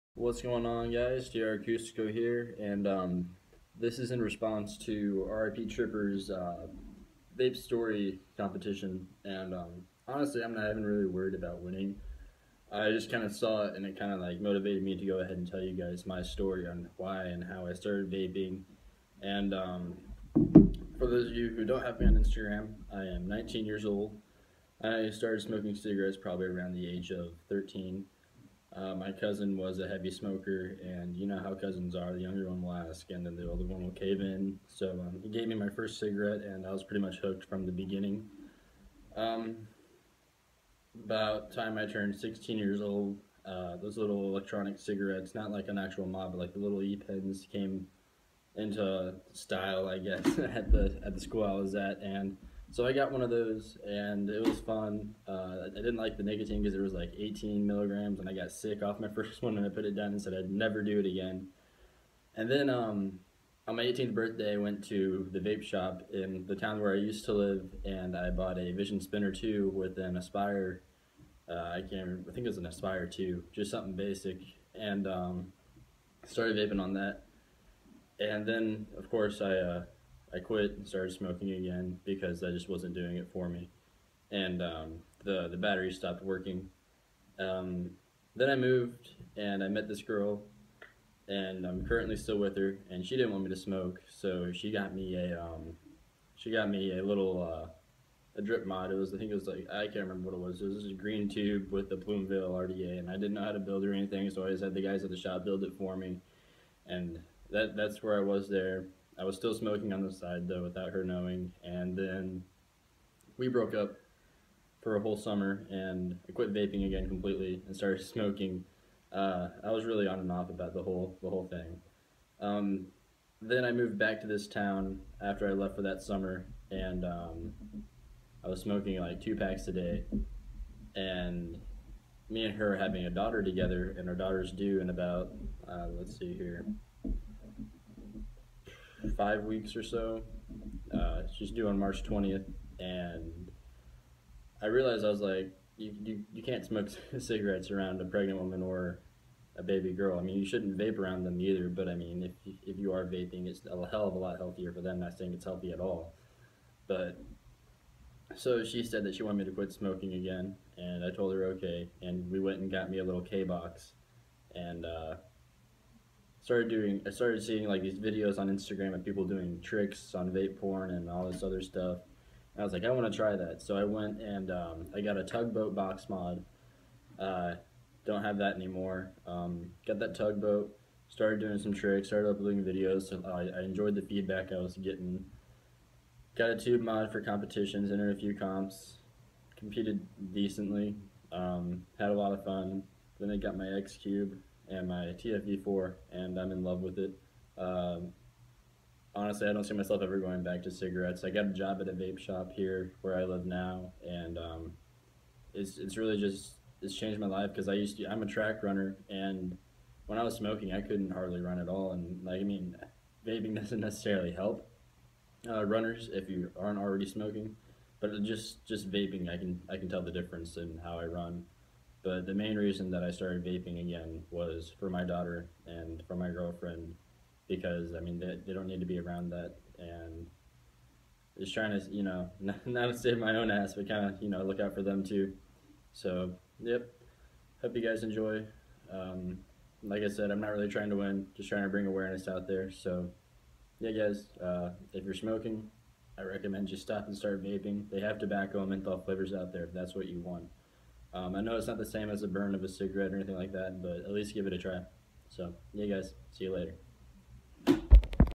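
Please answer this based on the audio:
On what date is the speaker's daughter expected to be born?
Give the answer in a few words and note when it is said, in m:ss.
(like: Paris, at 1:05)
March 20th, at 2:21.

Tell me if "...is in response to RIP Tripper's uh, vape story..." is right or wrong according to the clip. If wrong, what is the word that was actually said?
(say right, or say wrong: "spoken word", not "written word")
right.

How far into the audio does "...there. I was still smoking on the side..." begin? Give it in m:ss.
1:48.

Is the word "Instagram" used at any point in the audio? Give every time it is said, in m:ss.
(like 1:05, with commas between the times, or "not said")
0:22, 2:48.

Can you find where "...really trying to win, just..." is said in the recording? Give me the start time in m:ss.
4:00.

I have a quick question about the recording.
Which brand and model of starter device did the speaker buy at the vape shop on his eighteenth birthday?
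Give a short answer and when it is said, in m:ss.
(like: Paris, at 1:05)
Vision Spinner 2, at 1:08.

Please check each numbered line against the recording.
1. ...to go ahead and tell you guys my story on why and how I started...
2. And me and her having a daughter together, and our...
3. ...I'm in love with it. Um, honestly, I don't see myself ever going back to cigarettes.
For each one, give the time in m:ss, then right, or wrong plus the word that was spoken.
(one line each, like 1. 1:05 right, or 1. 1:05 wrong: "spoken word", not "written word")
1. 0:14 right
2. 2:10 right
3. 3:16 right.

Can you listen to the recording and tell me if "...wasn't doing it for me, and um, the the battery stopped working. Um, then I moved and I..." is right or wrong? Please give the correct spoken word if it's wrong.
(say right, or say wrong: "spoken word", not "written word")
right.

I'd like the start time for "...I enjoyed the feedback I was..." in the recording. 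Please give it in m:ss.
3:03.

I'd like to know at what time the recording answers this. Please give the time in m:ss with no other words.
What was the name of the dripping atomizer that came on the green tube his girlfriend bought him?
1:41.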